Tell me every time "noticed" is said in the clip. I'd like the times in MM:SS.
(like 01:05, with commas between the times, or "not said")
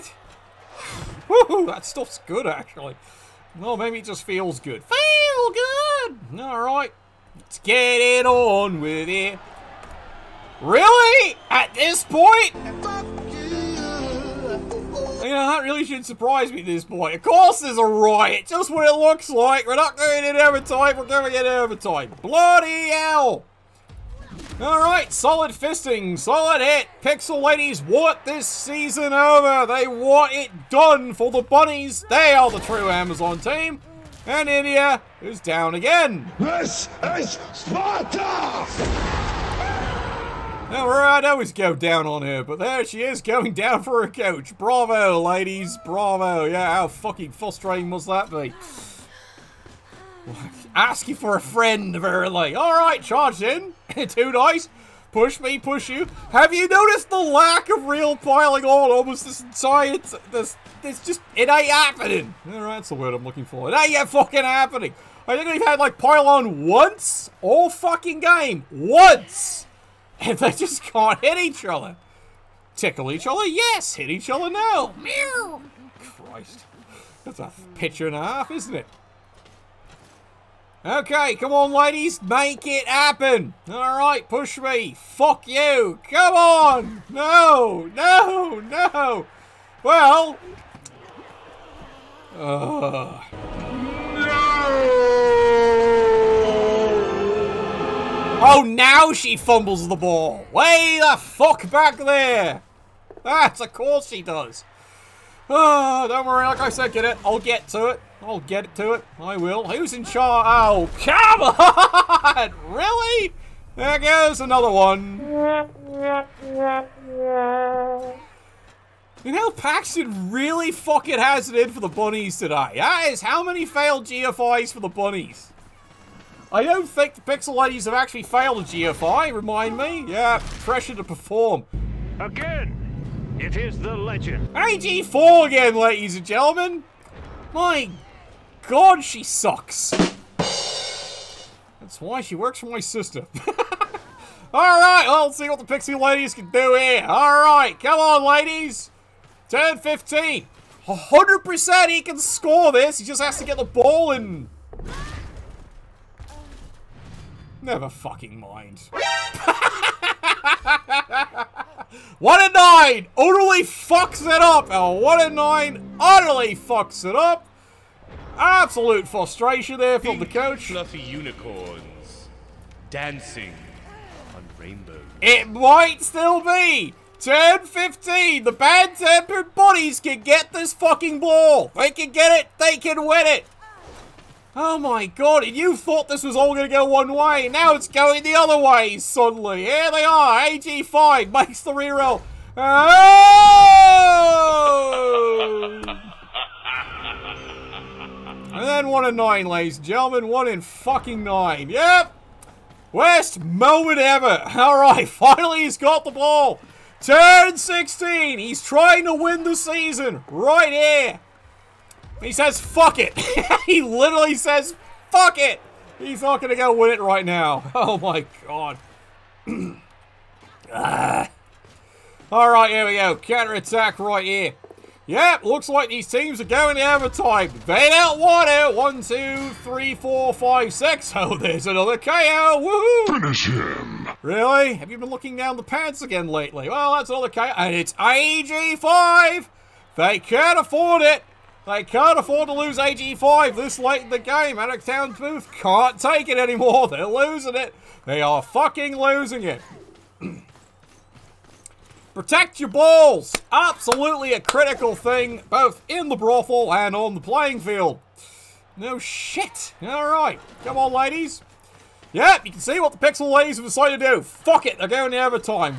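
00:56.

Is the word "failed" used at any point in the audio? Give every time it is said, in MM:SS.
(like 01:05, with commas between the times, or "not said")
02:03, 02:08.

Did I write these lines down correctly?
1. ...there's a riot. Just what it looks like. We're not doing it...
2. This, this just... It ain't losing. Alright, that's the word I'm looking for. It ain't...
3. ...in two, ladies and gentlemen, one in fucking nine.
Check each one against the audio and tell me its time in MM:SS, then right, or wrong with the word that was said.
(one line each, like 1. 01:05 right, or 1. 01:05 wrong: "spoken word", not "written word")
1. 00:17 right
2. 01:00 wrong: "happening", not "losing"
3. 03:19 wrong: "nine", not "two".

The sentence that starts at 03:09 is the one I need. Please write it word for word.
Here they are, AG5 makes the reroll.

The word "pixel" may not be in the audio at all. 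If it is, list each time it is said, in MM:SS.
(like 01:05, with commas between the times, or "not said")
00:27, 02:07, 04:22.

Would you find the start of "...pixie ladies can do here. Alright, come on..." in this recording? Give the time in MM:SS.
02:25.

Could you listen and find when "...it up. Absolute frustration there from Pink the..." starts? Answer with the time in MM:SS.
02:47.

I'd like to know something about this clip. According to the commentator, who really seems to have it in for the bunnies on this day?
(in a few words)
Paxton.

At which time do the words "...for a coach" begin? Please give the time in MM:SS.
00:43.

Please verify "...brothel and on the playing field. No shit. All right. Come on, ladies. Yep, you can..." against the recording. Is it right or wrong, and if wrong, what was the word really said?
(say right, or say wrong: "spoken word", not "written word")
right.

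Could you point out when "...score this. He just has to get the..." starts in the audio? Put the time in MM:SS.
02:32.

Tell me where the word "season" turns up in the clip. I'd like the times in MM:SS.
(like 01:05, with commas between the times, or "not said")
00:28, 03:29.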